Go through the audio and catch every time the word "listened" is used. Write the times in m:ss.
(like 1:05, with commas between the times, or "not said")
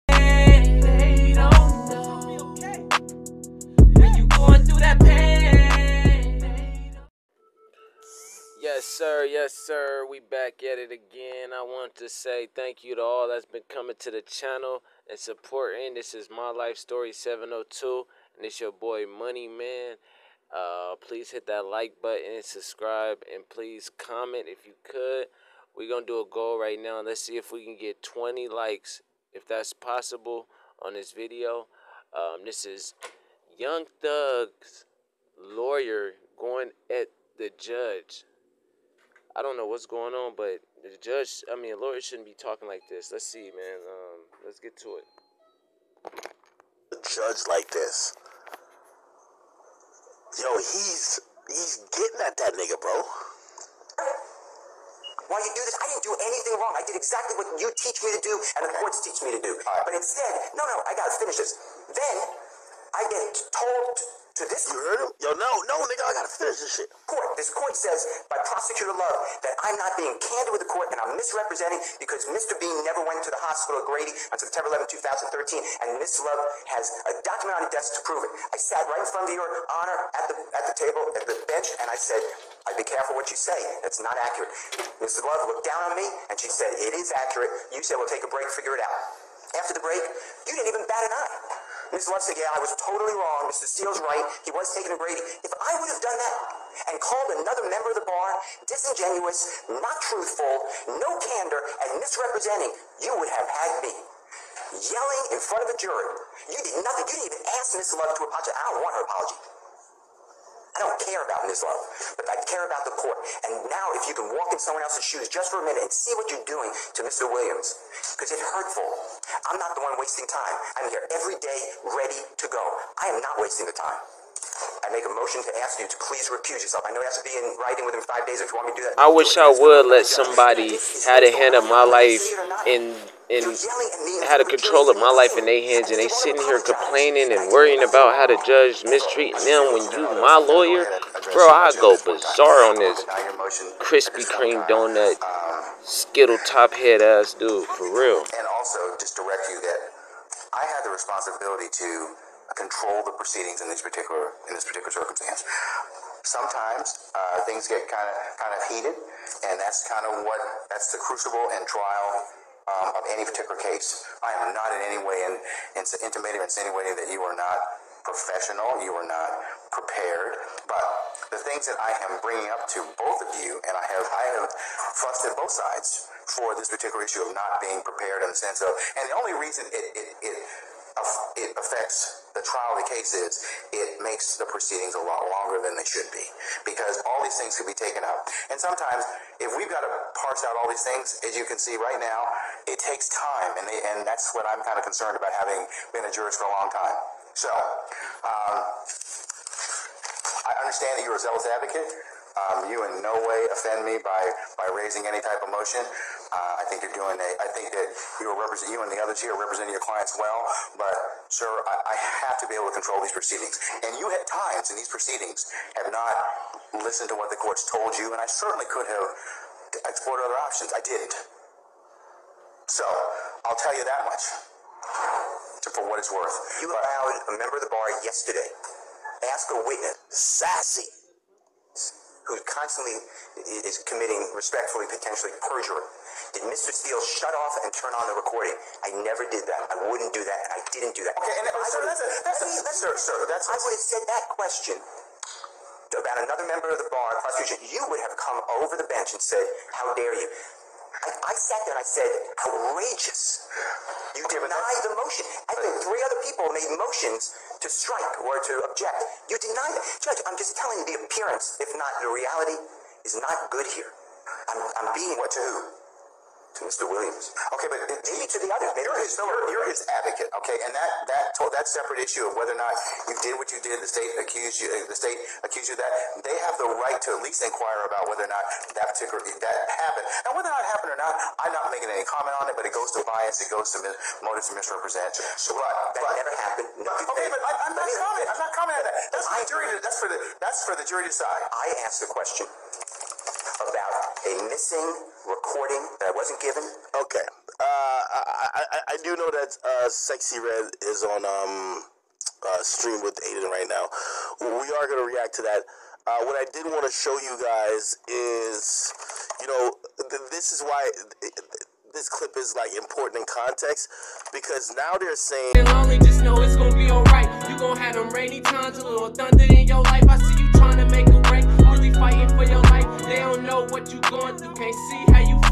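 3:36.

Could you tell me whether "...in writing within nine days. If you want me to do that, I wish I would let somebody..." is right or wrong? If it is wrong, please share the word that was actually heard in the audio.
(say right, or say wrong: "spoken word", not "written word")
wrong: "five", not "nine".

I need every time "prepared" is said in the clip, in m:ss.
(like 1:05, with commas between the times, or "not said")
2:49, 2:57.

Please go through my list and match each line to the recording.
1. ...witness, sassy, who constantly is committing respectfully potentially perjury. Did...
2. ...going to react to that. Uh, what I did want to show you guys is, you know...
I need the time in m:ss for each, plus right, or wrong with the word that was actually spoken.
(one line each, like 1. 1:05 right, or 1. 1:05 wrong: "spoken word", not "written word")
1. 3:49 right
2. 5:04 right.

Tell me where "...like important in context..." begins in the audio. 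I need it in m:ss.
5:12.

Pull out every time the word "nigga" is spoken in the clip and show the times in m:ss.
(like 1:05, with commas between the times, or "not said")
0:52, 1:05.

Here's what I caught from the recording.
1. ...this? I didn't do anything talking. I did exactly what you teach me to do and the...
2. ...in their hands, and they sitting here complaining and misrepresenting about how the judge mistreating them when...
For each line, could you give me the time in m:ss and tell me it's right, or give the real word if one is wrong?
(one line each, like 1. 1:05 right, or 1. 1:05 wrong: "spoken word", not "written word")
1. 0:55 wrong: "wrong", not "talking"
2. 2:15 wrong: "worrying", not "misrepresenting".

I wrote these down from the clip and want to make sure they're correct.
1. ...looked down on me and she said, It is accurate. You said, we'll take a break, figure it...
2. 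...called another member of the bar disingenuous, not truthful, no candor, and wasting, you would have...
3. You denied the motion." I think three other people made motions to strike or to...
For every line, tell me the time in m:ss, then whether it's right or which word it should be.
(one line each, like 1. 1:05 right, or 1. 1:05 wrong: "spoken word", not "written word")
1. 1:25 right
2. 1:36 wrong: "misrepresenting", not "wasting"
3. 4:14 right.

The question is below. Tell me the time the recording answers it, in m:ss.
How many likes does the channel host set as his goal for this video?
0:28.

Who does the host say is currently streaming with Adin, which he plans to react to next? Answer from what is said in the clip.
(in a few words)
Sexyy Red.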